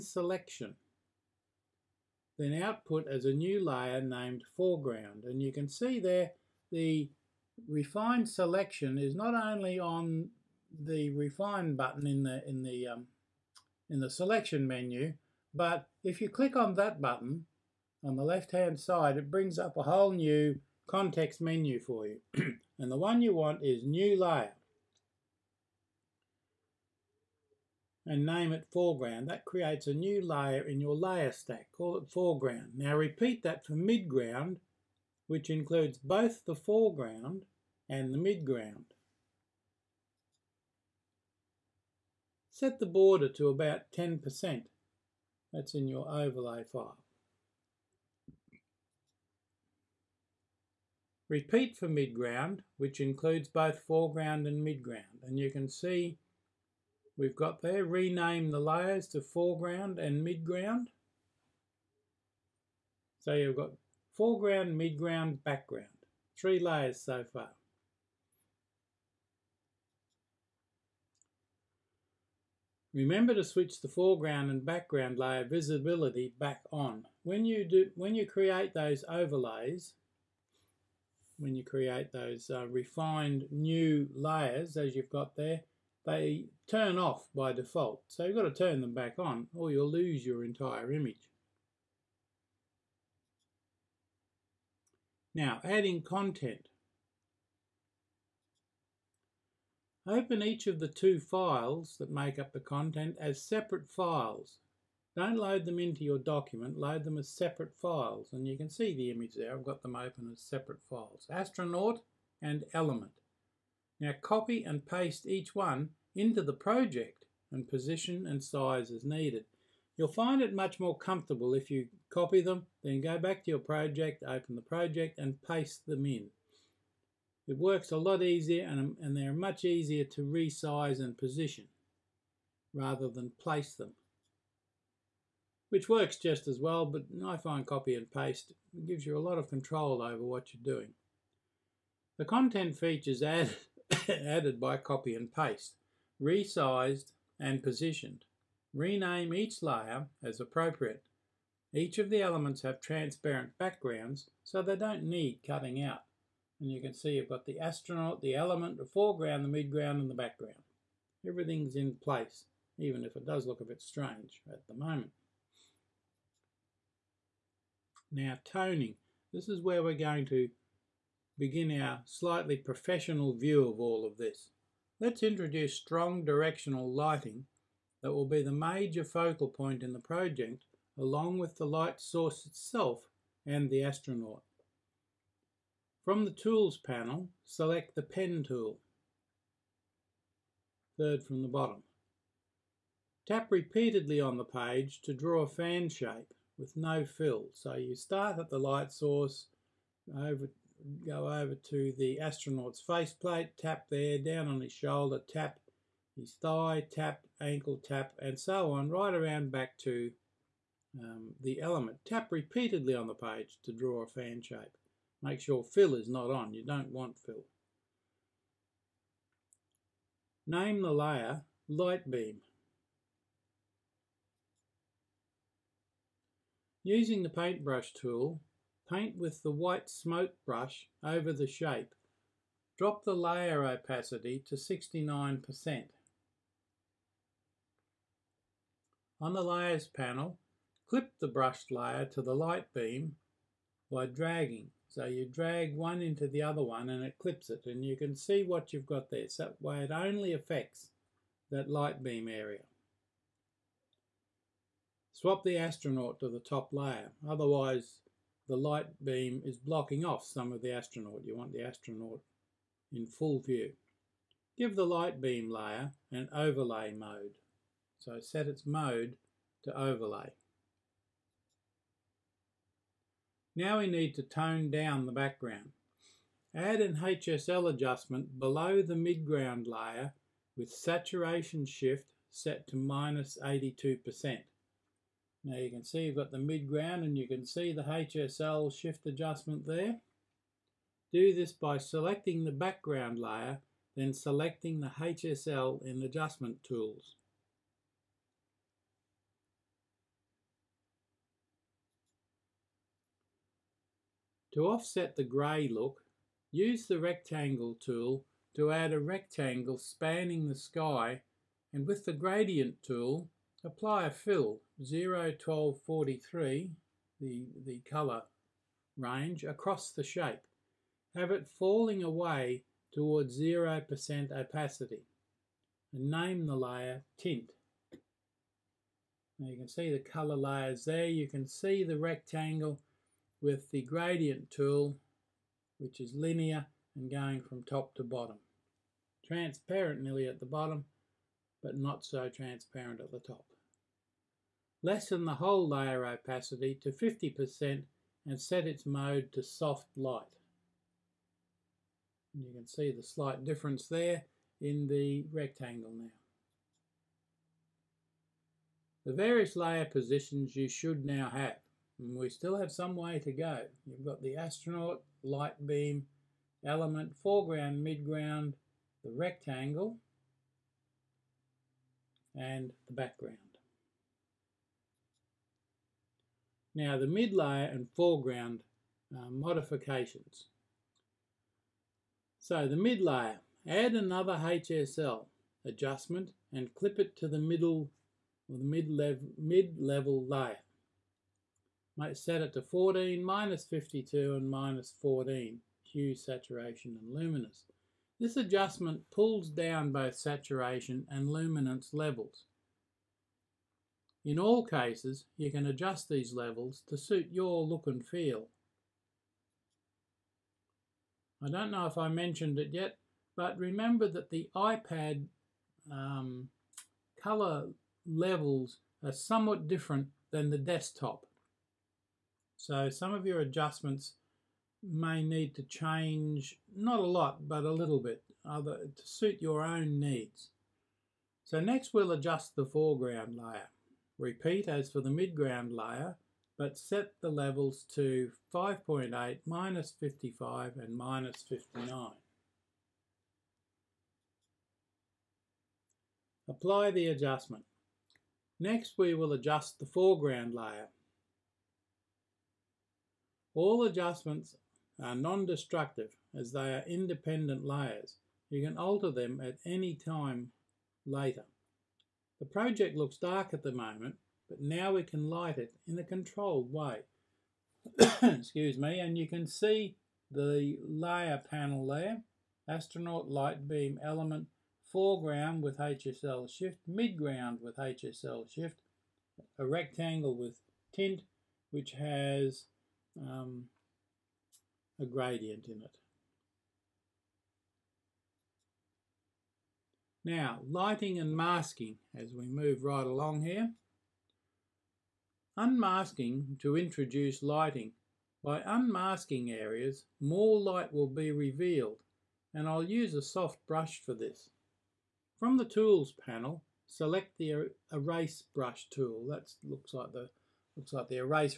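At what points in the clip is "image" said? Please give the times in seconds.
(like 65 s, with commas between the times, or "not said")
90 s, 109 s.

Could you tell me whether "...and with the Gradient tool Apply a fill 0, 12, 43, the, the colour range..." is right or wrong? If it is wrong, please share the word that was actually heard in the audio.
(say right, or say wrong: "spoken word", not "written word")
right.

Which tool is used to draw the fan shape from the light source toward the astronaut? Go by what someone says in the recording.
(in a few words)
Pen tool.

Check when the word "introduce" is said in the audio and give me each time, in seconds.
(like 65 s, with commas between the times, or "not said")
175 s, 496 s.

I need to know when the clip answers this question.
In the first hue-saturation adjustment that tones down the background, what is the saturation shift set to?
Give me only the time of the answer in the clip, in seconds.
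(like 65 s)
282 s.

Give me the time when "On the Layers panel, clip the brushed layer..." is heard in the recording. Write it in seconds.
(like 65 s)
239 s.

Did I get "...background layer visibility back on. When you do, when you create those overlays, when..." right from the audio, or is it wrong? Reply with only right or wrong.
right.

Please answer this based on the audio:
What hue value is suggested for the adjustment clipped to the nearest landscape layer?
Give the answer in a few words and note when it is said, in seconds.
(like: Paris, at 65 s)
5.8, at 438 s.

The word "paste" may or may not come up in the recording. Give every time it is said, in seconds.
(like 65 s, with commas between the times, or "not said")
114 s, 125 s, 138 s, 145 s.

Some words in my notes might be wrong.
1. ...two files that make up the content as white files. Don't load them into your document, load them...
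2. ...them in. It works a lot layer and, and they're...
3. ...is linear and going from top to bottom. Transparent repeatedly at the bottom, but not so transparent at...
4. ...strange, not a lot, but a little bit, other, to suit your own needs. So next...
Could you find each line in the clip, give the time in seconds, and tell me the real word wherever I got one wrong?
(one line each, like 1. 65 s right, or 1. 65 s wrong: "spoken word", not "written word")
1. 100 s wrong: "separate", not "white"
2. 125 s wrong: "easier", not "layer"
3. 335 s wrong: "nearly", not "repeatedly"
4. 425 s wrong: "change", not "strange".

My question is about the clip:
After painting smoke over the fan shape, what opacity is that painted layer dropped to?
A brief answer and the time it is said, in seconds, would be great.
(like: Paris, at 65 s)
69%, at 234 s.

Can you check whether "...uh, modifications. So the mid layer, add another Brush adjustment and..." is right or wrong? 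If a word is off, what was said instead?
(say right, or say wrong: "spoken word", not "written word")
wrong: "HSL", not "Brush".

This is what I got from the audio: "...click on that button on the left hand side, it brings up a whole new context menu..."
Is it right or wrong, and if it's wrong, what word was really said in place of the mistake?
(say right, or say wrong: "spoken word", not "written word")
right.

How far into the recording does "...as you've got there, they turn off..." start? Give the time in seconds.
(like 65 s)
84 s.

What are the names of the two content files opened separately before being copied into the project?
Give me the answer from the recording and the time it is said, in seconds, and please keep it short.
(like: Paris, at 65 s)
Astronaut and Element, at 111 s.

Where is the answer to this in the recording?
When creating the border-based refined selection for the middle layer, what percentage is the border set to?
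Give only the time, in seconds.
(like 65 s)
43 s.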